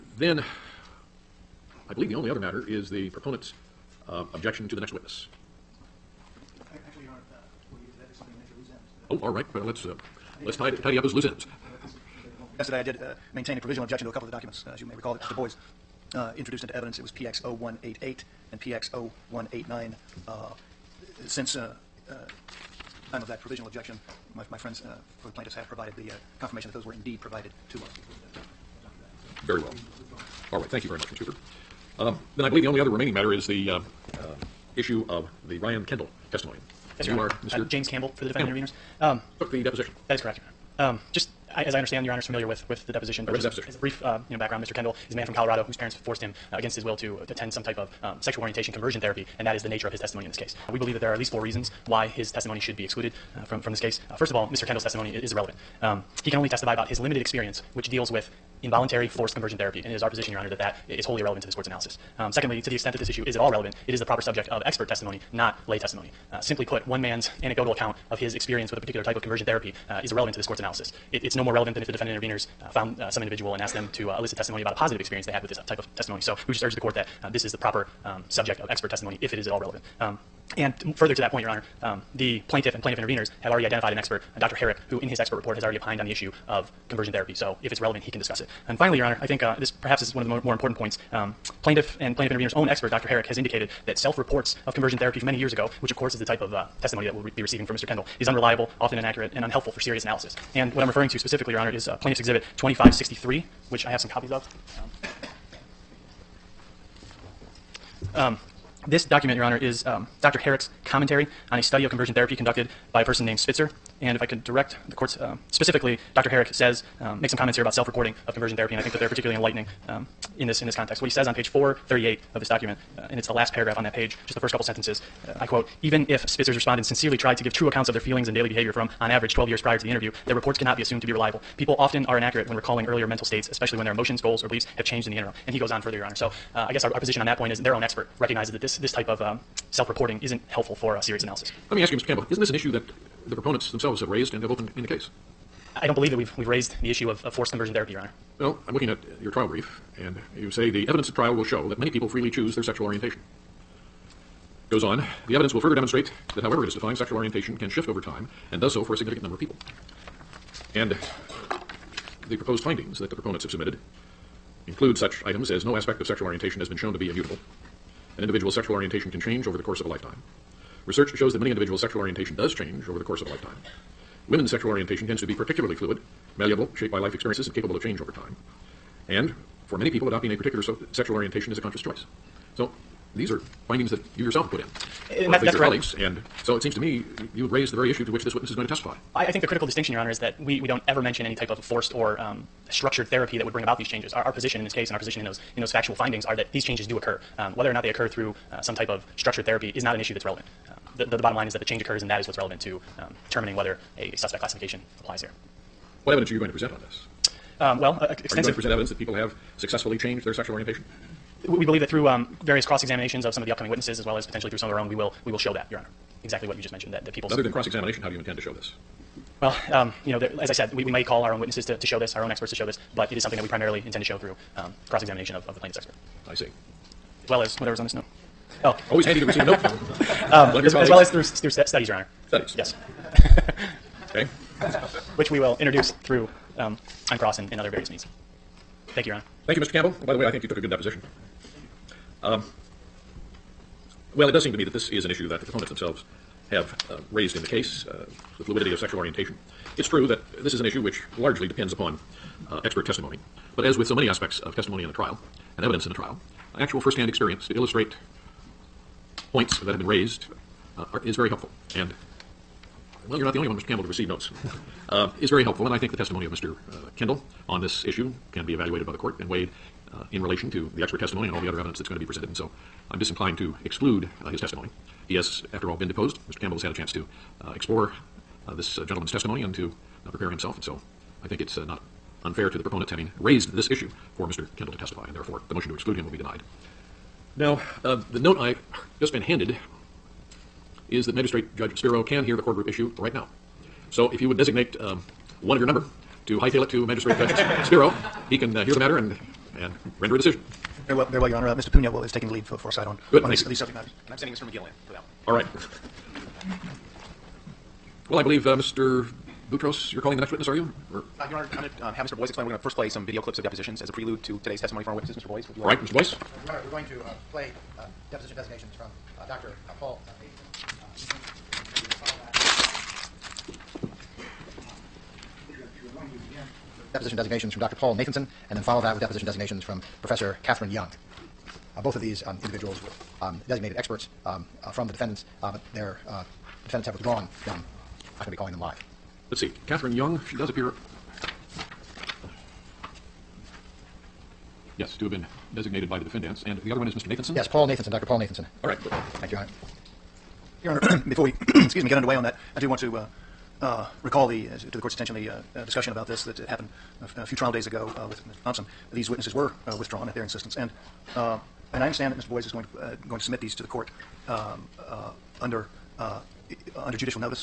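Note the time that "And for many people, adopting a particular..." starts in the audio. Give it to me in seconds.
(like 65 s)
179 s.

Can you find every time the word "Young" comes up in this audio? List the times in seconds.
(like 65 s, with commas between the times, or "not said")
330 s, 339 s.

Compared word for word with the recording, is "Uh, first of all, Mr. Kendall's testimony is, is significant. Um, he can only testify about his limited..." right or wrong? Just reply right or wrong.
wrong.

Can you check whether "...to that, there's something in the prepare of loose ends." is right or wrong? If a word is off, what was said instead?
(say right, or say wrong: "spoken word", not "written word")
wrong: "nature", not "prepare".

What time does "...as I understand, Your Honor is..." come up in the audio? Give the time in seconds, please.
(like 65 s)
41 s.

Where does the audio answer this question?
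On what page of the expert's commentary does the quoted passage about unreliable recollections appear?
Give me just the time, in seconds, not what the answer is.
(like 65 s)
121 s.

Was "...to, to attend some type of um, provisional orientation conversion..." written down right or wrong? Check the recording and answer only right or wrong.
wrong.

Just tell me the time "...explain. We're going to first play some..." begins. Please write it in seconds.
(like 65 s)
312 s.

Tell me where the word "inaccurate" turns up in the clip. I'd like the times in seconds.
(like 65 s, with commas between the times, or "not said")
98 s, 132 s.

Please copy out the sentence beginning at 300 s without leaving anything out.
Very well, very well, Your Honor.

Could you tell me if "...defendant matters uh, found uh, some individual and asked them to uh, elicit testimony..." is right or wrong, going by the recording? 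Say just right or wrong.
wrong.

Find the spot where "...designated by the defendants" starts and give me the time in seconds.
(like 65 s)
345 s.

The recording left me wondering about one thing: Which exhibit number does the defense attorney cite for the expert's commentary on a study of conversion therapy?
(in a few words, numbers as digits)
Plaintiff's Exhibit 2563.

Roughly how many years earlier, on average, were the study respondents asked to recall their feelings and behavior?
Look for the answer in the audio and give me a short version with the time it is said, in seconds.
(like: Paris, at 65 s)
12, at 129 s.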